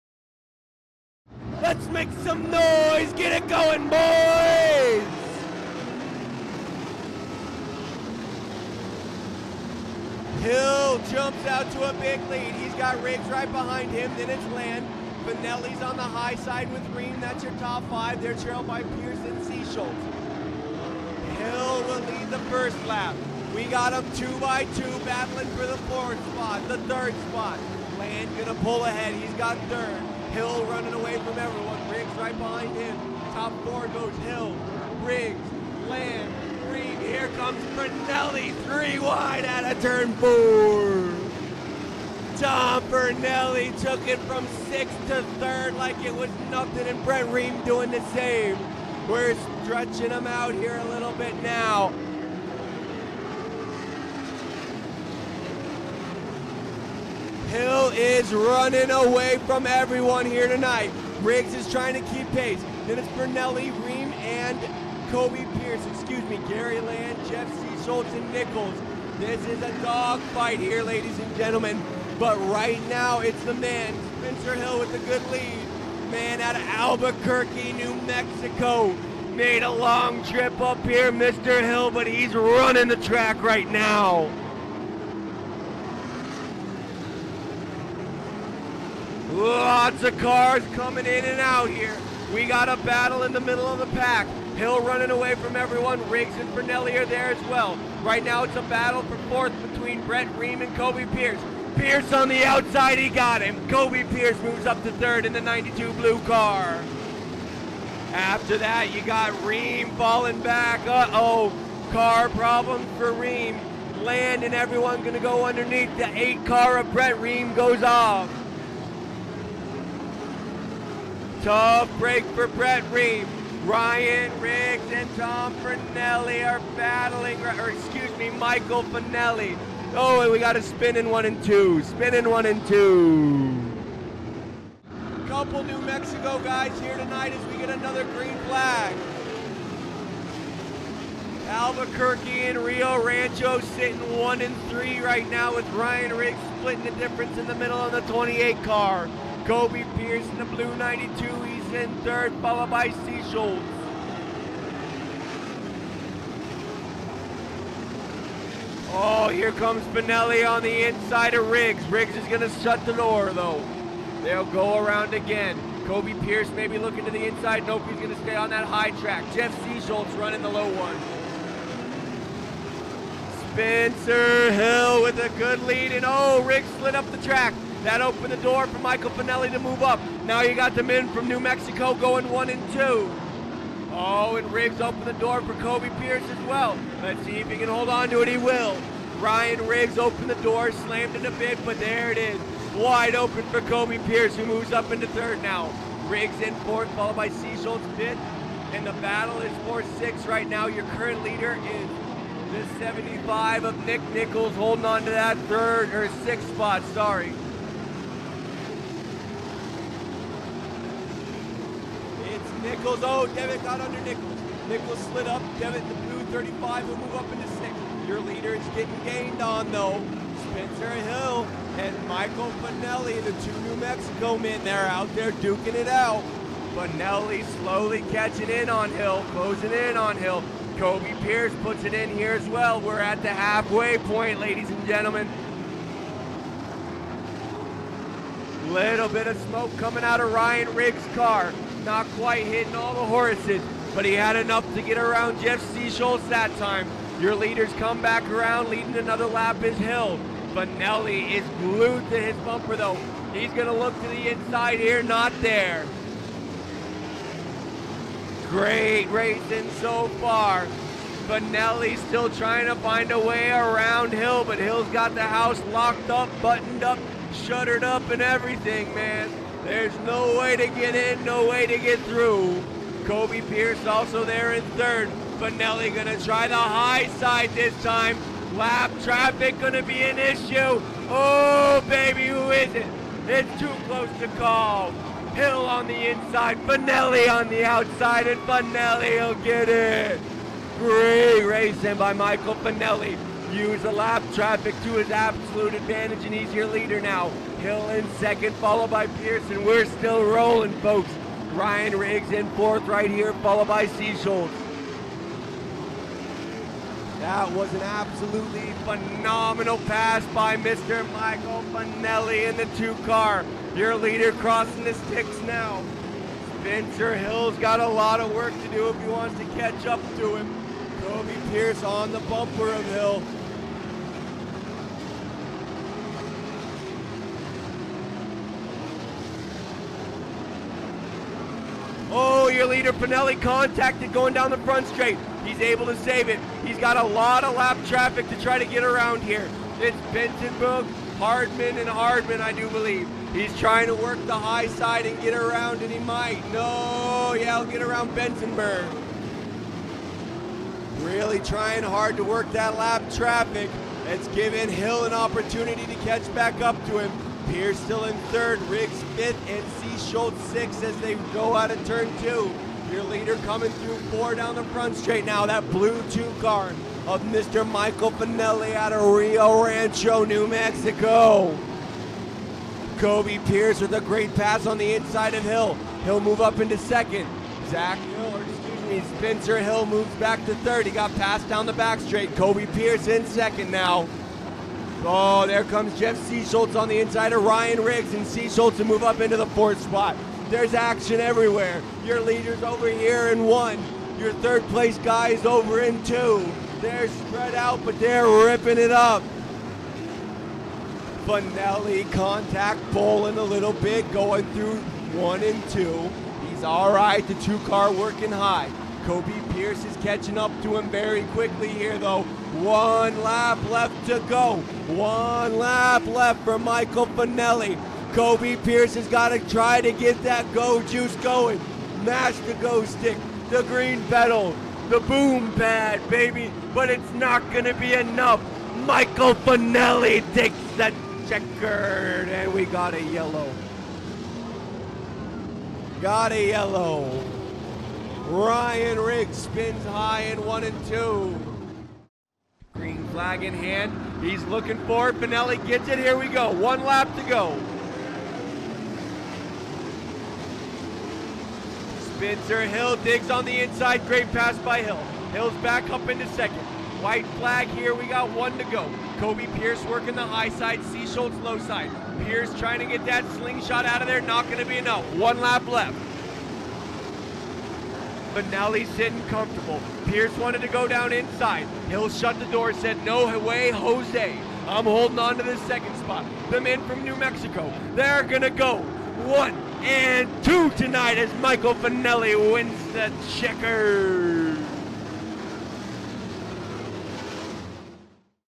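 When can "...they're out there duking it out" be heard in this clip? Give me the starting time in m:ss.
3:44.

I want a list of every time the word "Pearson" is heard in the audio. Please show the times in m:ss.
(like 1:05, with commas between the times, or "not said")
0:18, 4:59.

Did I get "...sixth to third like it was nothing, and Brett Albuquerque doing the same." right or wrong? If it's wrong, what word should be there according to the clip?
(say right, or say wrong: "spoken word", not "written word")
wrong: "Ream", not "Albuquerque".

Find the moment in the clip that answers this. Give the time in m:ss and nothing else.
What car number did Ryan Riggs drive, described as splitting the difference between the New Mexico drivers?
2:28.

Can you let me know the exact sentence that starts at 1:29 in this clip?
Lots of cars coming in and out here.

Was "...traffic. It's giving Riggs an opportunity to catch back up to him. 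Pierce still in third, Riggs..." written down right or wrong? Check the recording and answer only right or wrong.
wrong.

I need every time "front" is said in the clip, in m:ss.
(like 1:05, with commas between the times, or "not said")
5:34, 6:04.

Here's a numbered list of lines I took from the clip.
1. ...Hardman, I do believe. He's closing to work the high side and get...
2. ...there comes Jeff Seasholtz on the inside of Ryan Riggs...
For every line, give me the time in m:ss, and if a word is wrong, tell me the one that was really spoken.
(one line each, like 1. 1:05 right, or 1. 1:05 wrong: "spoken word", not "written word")
1. 5:41 wrong: "trying", not "closing"
2. 6:25 right.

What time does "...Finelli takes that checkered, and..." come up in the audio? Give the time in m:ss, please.
7:09.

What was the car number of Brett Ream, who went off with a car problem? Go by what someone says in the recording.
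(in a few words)
8.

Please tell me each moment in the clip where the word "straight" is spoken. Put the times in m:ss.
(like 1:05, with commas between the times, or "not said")
5:34, 6:04, 6:22.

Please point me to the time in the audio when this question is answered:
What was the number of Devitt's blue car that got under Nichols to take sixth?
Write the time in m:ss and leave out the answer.
3:36.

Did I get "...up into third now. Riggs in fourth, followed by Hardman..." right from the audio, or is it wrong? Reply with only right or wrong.
wrong.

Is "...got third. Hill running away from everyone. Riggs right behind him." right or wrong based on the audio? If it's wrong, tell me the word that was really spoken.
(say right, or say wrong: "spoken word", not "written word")
right.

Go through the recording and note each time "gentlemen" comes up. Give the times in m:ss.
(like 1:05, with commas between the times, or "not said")
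1:11, 3:54.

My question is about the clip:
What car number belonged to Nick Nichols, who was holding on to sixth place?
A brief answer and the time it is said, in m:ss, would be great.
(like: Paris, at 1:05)
75, at 3:22.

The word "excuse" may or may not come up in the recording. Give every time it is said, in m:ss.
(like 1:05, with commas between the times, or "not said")
1:05, 2:07.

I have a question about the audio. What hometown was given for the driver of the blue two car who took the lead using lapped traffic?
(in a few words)
Rio Rancho, New Mexico.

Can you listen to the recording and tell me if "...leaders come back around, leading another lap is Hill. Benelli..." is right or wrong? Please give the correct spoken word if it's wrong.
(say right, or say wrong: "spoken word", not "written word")
right.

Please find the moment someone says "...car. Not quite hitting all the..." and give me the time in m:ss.
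4:01.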